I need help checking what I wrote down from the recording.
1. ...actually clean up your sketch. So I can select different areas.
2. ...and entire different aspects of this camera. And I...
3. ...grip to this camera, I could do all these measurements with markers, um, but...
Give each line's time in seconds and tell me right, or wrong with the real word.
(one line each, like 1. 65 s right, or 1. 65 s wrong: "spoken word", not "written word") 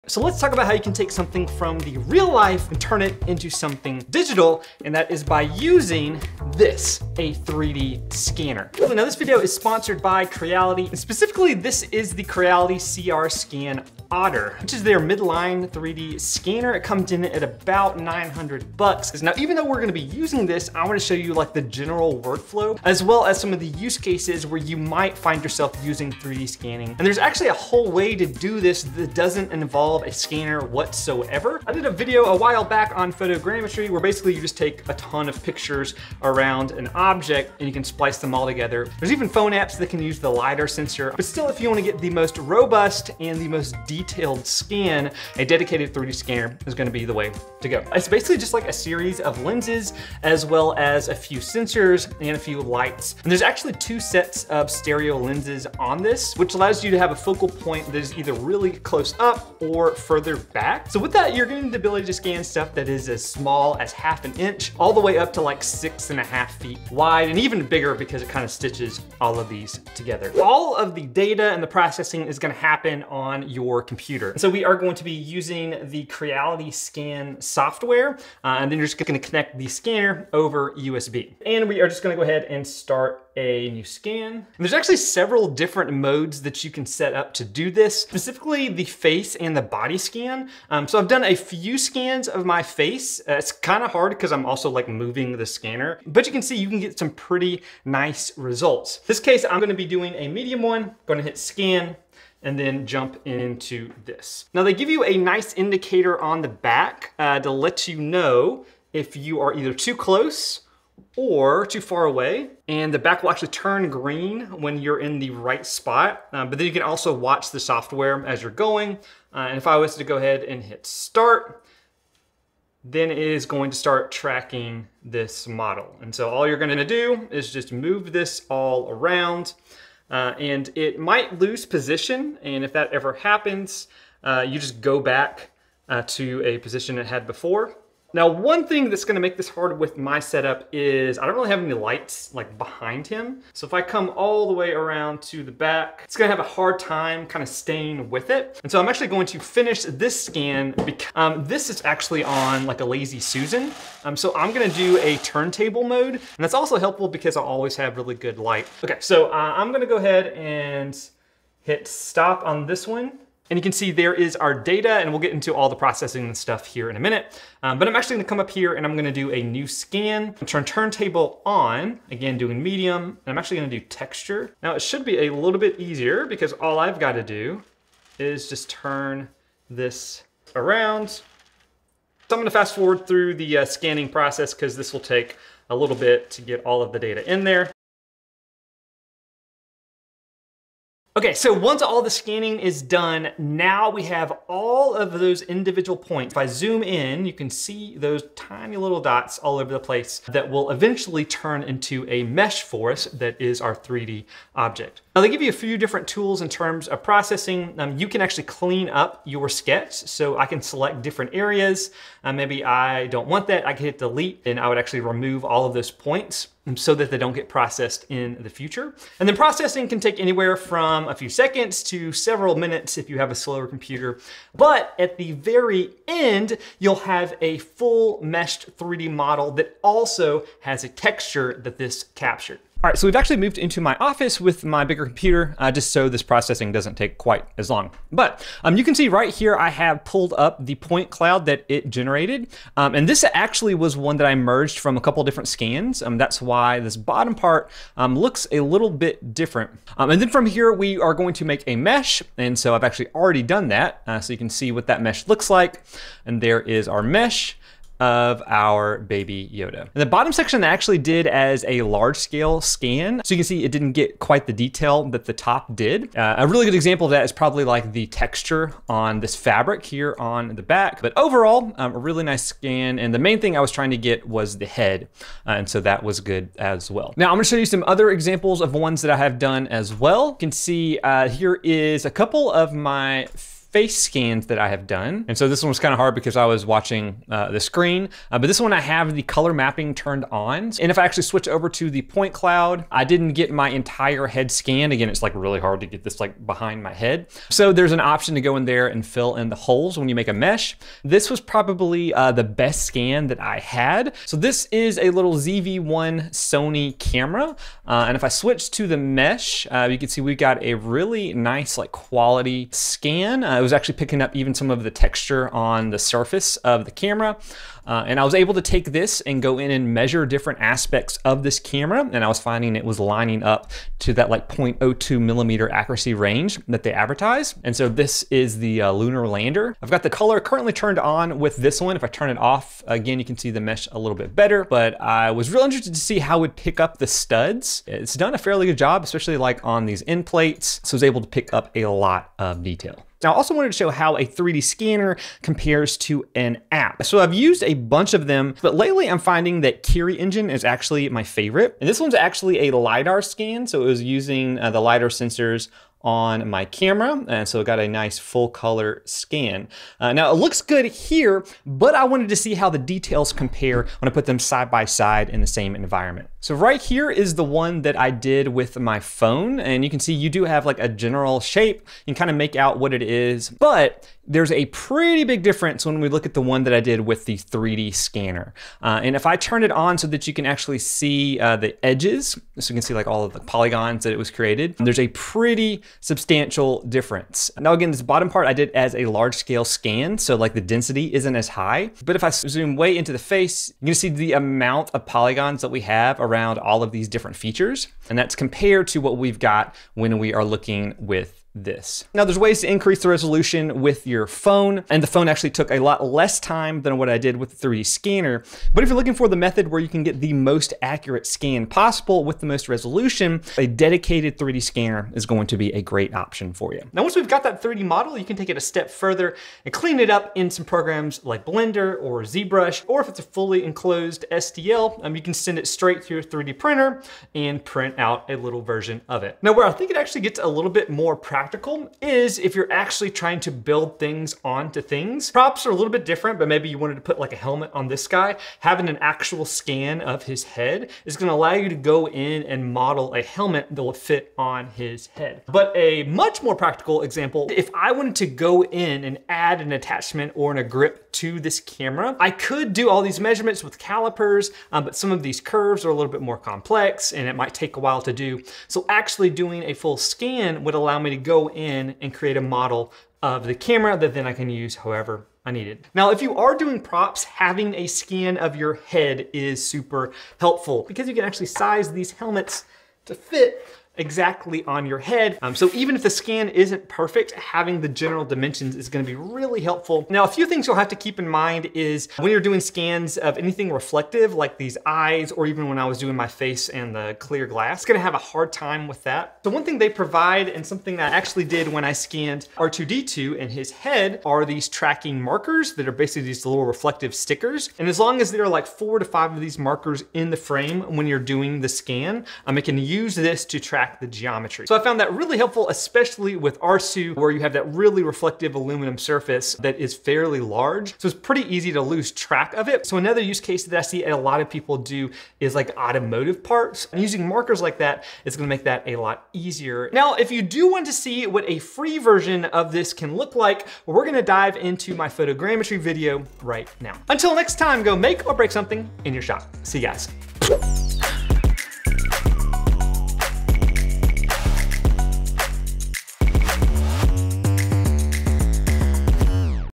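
1. 208 s right
2. 319 s wrong: "measure", not "entire"
3. 450 s wrong: "calipers", not "markers".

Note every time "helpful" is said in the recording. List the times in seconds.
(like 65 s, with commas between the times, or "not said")
156 s, 470 s, 479 s, 505 s.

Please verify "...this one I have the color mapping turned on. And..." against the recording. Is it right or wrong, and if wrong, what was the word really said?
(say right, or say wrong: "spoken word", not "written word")
right.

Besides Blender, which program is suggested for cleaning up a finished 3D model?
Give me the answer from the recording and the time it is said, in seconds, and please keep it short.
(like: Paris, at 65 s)
ZBrush, at 422 s.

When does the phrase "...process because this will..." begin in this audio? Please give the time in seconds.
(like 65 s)
184 s.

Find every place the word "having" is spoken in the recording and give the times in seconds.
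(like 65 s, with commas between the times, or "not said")
438 s, 467 s, 477 s.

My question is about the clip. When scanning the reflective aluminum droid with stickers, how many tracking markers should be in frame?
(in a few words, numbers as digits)
4 to 5.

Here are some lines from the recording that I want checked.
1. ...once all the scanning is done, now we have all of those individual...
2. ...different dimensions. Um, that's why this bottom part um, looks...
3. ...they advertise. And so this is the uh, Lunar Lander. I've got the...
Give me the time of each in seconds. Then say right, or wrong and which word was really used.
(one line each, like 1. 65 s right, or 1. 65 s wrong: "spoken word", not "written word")
1. 191 s right
2. 245 s wrong: "scans", not "dimensions"
3. 326 s right.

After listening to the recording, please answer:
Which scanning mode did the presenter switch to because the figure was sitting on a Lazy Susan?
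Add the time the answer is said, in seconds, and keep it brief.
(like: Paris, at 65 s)
turntable mode, at 155 s.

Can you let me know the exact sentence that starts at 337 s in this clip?
It's done a fairly good job, especially like on these end plates.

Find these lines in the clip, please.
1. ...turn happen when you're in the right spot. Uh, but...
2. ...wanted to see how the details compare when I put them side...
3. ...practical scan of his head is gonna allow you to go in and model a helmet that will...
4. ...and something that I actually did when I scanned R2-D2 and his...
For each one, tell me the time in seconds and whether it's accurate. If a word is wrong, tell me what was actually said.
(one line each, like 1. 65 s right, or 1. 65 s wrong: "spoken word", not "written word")
1. 113 s wrong: "green", not "happen"
2. 362 s right
3. 438 s wrong: "actual", not "practical"
4. 490 s right.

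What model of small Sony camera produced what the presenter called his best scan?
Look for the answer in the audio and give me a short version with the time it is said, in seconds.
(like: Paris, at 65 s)
ZV-1, at 305 s.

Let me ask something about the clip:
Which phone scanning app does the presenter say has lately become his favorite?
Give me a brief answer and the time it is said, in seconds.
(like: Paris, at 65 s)
Kiri Engine, at 349 s.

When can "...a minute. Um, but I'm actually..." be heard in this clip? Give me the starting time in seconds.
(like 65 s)
166 s.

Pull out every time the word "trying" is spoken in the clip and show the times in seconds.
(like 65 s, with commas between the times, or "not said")
273 s, 433 s.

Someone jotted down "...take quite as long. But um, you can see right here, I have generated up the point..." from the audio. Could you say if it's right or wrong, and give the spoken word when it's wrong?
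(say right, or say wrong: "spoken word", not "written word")
wrong: "pulled", not "generated".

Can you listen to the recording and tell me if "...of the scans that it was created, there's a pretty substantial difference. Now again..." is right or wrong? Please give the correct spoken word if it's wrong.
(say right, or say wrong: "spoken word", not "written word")
wrong: "polygons", not "scans".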